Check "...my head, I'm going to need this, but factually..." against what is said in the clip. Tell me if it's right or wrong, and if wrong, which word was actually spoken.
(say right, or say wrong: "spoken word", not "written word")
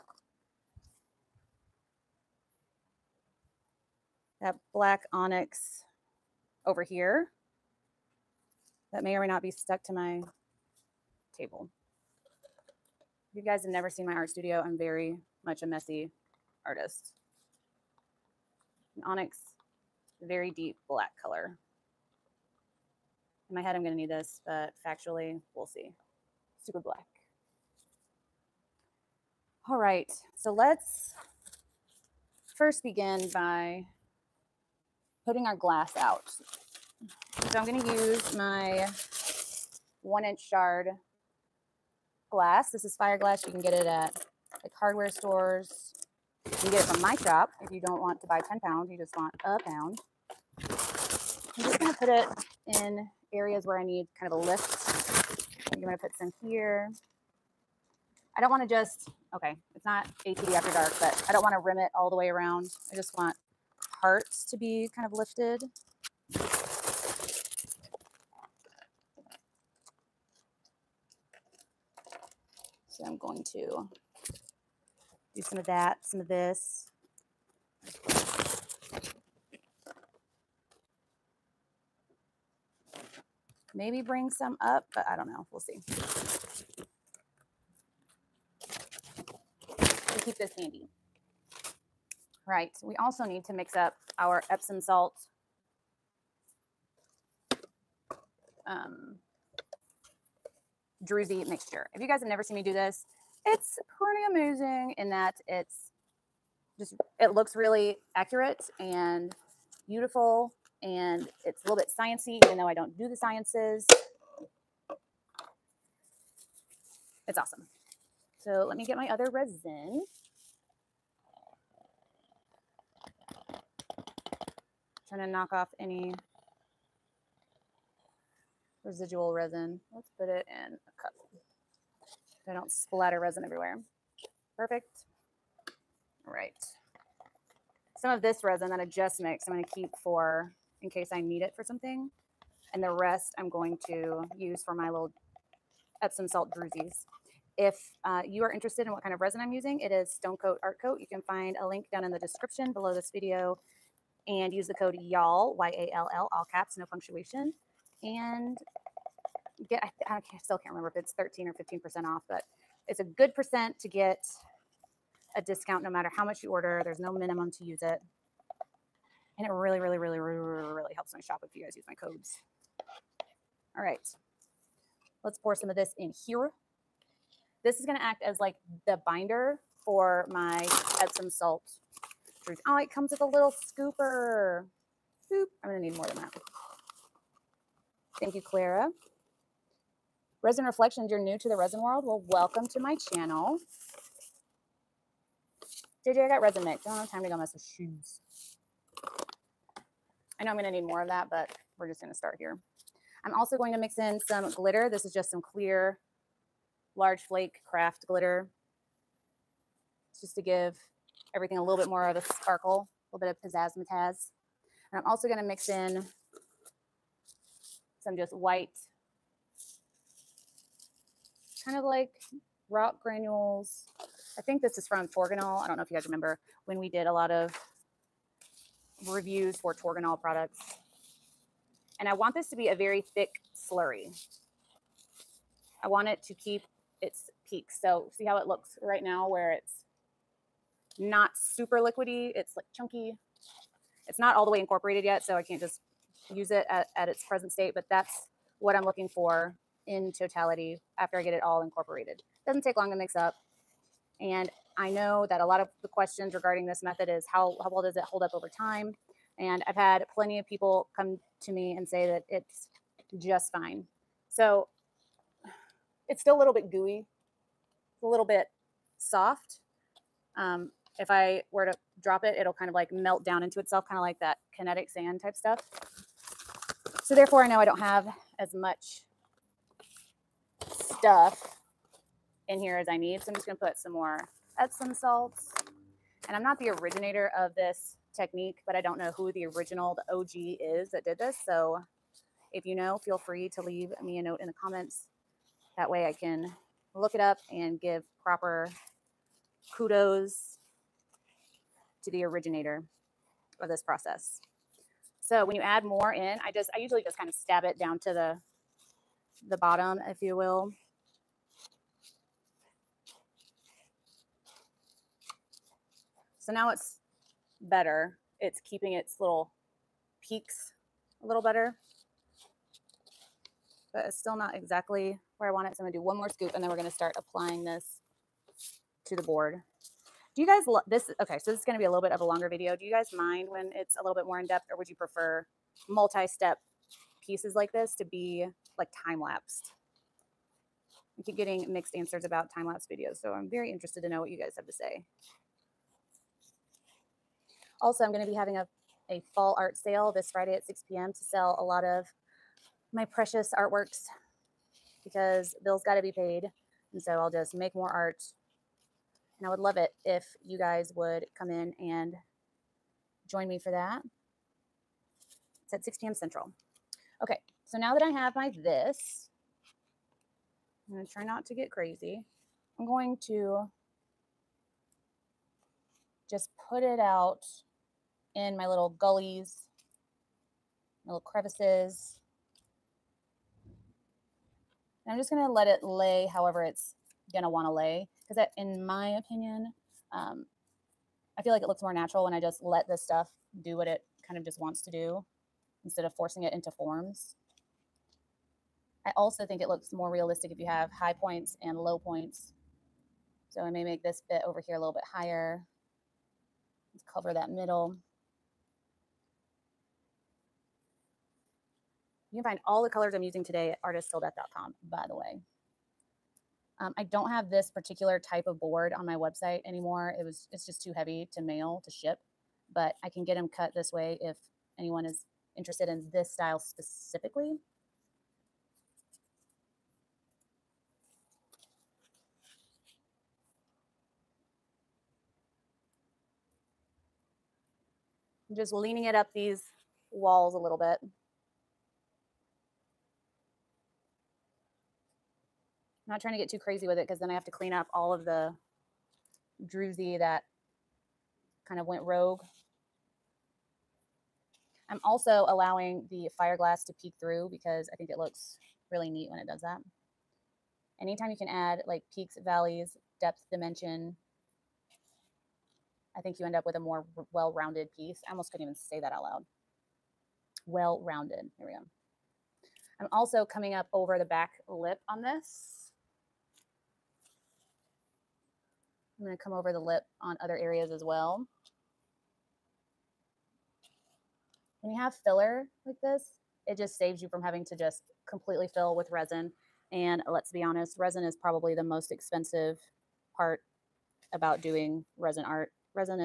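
right.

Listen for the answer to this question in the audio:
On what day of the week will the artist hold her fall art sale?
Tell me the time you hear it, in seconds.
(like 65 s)
350 s.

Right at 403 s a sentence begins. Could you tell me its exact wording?
So I may make this bit over here a little bit higher cover that middle.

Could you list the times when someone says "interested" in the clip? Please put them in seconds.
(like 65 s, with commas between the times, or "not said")
148 s, 343 s, 425 s.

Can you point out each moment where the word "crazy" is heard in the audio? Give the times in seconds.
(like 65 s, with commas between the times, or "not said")
371 s, 446 s.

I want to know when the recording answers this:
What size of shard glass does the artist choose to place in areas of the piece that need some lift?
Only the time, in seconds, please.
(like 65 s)
40 s.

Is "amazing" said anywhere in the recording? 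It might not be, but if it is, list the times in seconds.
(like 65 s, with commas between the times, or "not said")
104 s.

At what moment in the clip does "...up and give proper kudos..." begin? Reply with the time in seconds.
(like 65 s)
297 s.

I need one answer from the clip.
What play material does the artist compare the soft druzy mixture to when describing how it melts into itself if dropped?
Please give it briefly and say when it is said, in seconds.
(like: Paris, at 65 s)
kinetic sand, at 274 s.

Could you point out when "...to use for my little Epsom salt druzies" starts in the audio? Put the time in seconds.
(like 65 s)
143 s.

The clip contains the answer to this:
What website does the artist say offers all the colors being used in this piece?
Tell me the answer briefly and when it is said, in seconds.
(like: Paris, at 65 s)
artisttilldeath.com, at 413 s.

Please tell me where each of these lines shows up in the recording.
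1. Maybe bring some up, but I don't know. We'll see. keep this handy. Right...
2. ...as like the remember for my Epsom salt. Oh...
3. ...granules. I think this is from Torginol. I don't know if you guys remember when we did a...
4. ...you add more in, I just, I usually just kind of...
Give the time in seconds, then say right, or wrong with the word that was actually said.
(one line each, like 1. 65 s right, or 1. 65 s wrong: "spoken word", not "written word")
1. 83 s right
2. 178 s wrong: "binder", not "remember"
3. 223 s right
4. 305 s right.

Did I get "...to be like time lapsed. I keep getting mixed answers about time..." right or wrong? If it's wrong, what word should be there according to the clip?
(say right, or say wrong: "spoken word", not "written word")
right.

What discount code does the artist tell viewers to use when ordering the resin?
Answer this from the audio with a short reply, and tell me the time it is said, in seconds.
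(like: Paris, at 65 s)
YALL, at 154 s.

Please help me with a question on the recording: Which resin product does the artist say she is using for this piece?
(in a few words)
Stone Coat Art Coat.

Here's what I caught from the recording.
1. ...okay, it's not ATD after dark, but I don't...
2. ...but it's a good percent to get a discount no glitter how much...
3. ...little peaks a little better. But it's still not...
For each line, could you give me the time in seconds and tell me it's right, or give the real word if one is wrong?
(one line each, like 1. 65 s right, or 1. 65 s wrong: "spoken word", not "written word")
1. 59 s right
2. 162 s wrong: "matter", not "glitter"
3. 319 s right.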